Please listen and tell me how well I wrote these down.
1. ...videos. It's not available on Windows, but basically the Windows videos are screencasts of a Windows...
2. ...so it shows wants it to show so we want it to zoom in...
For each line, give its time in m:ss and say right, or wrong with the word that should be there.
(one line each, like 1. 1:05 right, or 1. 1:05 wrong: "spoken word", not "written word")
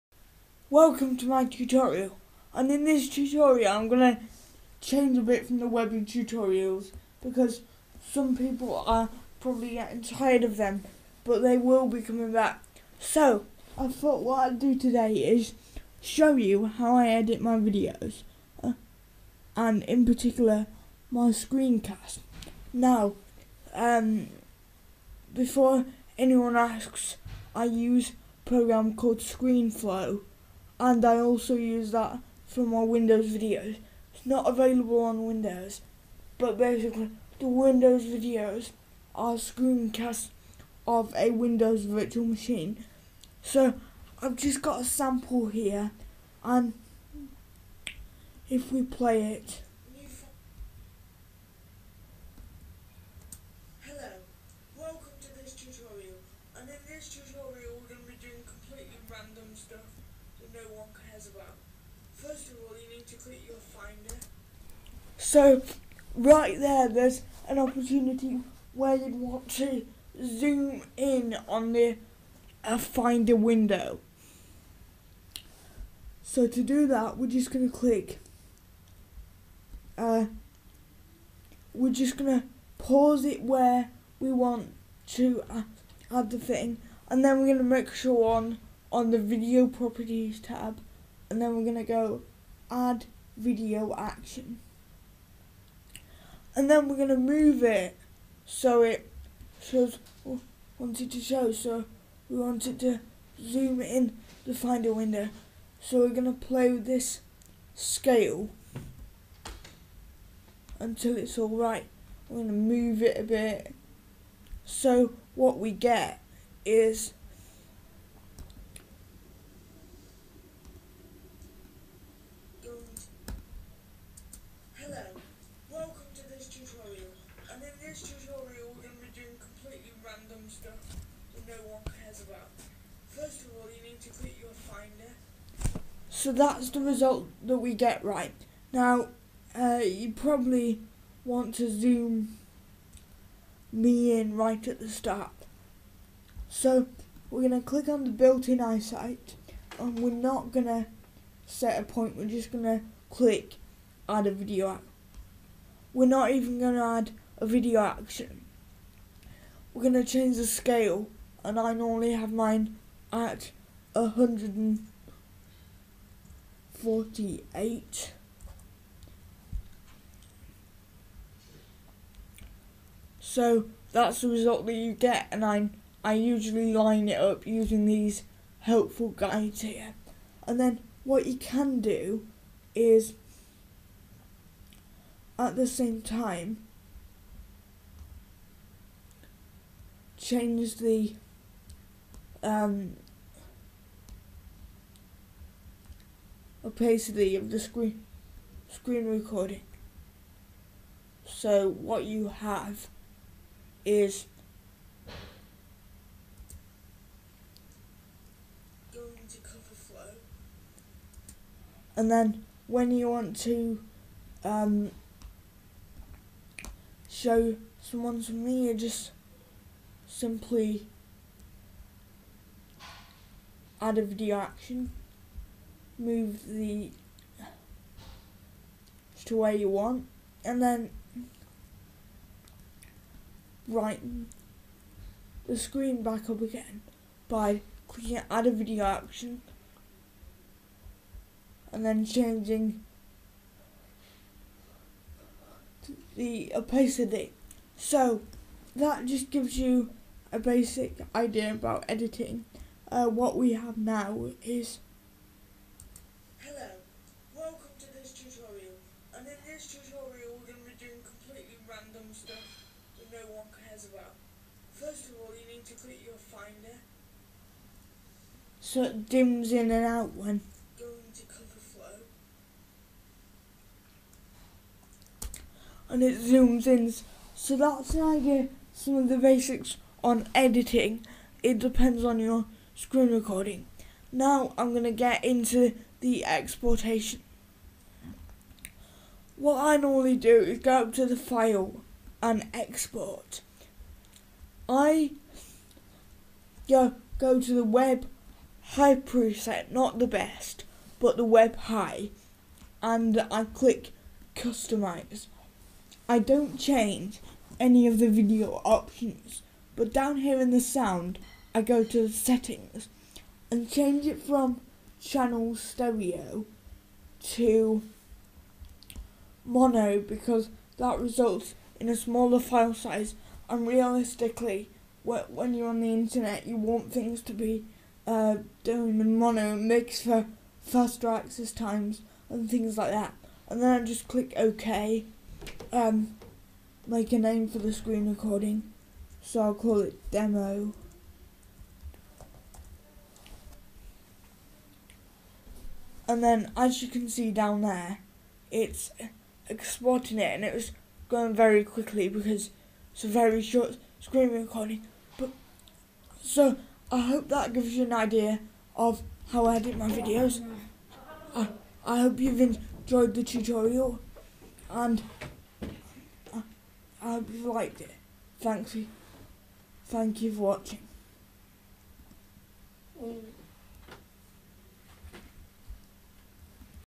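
1. 0:33 right
2. 1:38 right.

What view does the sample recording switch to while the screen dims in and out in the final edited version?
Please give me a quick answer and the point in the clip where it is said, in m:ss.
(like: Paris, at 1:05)
cover flow, at 4:31.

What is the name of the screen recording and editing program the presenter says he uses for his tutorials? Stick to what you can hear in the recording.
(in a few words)
ScreenFlow.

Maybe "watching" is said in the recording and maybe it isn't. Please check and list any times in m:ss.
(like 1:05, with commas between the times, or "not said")
6:10.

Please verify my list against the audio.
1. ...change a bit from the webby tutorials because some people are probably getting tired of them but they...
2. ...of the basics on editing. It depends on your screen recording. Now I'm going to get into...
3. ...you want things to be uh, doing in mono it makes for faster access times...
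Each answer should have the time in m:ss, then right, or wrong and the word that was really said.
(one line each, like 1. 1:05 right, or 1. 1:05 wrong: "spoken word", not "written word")
1. 0:04 right
2. 4:38 right
3. 5:26 right.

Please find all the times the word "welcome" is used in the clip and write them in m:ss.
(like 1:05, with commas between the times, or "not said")
0:00, 4:17.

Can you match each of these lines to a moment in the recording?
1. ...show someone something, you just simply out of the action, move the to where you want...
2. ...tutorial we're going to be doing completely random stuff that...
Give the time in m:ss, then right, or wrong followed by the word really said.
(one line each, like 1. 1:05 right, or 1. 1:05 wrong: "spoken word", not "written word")
1. 3:37 right
2. 4:19 right.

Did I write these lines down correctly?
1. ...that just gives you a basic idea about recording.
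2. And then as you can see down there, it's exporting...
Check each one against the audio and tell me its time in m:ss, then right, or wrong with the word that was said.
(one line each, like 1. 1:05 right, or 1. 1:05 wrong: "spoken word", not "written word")
1. 4:08 wrong: "editing", not "recording"
2. 5:46 right.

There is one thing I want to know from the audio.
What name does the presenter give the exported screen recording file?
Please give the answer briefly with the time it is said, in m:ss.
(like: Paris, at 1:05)
demo, at 5:40.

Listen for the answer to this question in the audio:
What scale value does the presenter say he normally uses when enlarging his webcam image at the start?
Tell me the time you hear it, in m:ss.
2:43.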